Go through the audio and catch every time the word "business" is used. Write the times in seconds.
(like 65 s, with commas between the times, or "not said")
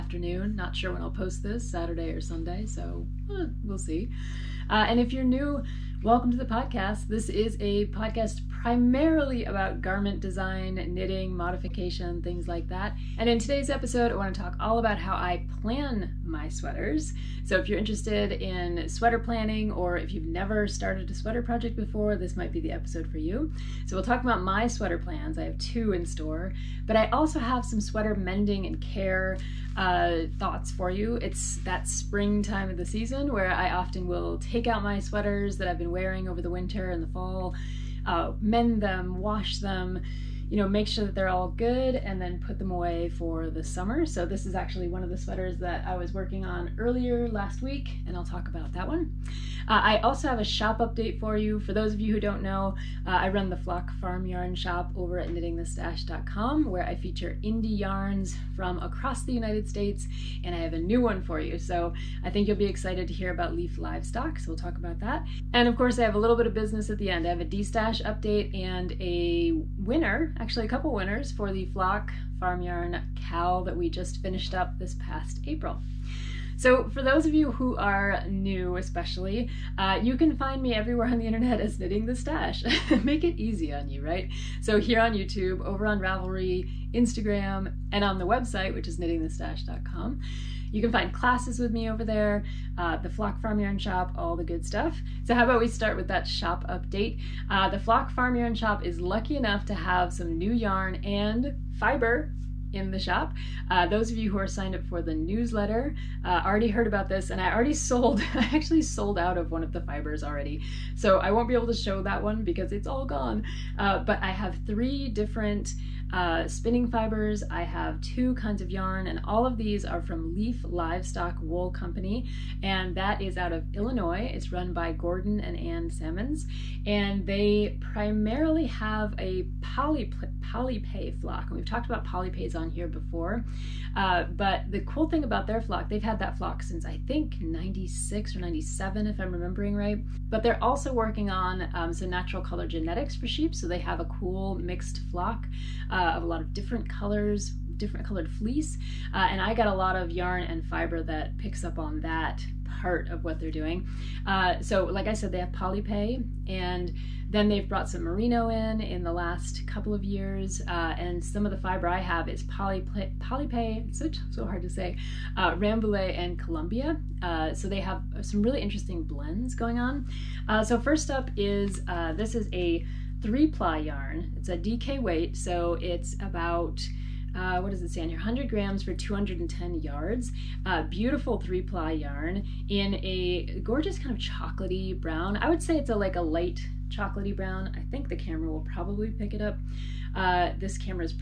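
66 s.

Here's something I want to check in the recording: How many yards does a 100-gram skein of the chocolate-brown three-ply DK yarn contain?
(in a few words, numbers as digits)
210 yards.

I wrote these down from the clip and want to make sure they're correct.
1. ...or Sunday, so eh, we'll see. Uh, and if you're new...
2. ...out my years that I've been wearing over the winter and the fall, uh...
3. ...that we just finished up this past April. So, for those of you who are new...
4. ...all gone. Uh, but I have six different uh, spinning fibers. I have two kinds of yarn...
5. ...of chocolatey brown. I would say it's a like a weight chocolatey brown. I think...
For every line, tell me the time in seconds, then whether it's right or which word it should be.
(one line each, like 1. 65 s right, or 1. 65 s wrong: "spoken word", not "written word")
1. 2 s right
2. 34 s wrong: "sweaters", not "years"
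3. 73 s right
4. 112 s wrong: "three", not "six"
5. 184 s wrong: "light", not "weight".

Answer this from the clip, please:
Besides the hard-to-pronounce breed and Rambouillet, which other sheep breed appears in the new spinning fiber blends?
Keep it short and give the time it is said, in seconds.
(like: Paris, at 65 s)
Columbia, at 166 s.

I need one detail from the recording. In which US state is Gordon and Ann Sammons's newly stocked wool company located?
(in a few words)
Illinois.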